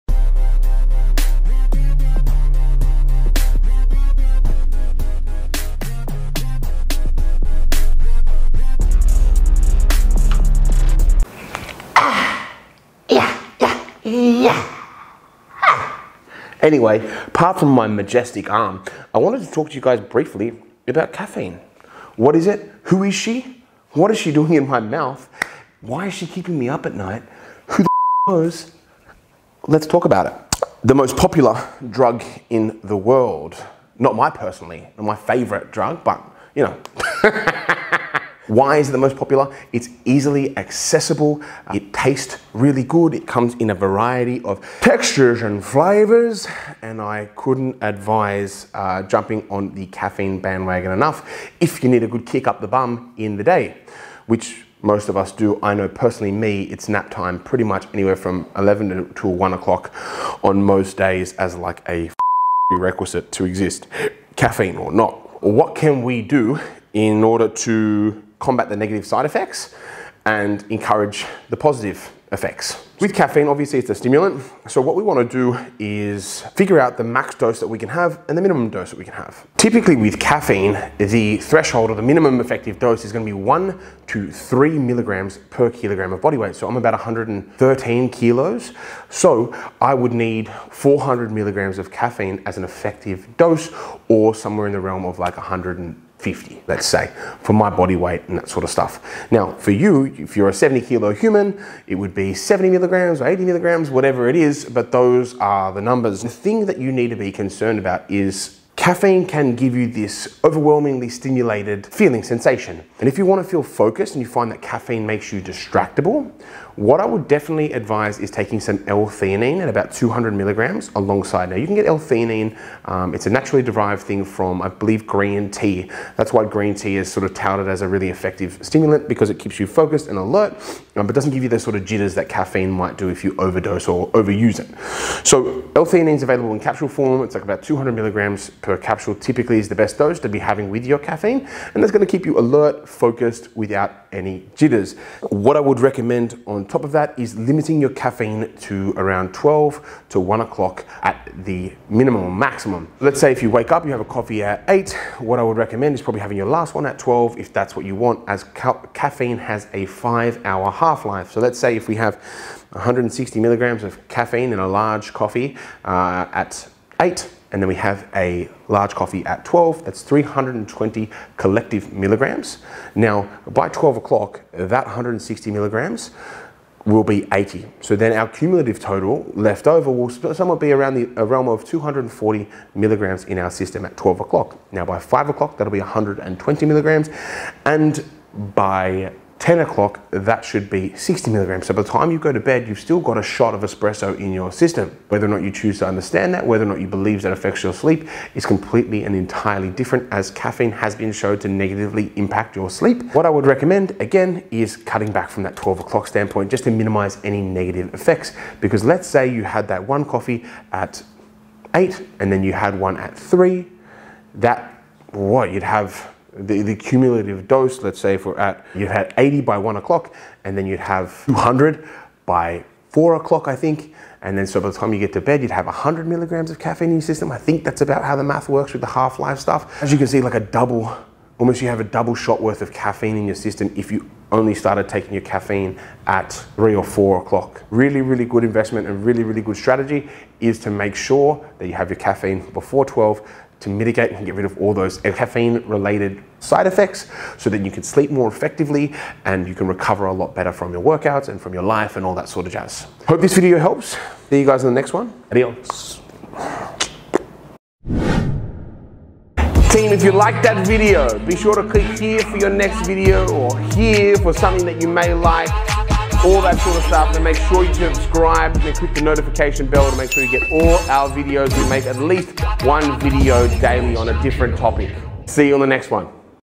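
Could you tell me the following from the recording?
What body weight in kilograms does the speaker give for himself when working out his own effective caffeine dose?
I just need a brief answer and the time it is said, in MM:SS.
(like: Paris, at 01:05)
113, at 01:26.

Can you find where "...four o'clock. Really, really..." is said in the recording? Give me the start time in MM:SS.
03:56.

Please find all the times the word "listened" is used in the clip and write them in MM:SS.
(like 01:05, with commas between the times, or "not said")
not said.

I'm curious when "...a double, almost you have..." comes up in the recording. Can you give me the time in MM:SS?
03:50.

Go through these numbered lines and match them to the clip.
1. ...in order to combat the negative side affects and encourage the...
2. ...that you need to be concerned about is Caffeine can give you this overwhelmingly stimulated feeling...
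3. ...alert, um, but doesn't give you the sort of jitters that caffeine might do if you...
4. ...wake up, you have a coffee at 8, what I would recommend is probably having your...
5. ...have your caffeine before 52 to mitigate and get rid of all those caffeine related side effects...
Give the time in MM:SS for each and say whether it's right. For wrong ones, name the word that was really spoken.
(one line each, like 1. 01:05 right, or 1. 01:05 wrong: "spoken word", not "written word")
1. 01:06 wrong: "effects", not "affects"
2. 01:46 right
3. 02:10 right
4. 02:33 right
5. 04:01 wrong: "12", not "52".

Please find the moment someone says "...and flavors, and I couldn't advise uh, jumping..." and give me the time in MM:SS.
00:45.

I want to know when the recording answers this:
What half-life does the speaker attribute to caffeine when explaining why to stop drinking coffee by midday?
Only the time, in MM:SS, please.
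02:39.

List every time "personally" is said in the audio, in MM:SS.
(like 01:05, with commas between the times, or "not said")
00:34, 00:55.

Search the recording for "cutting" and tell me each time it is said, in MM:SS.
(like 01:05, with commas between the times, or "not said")
03:24.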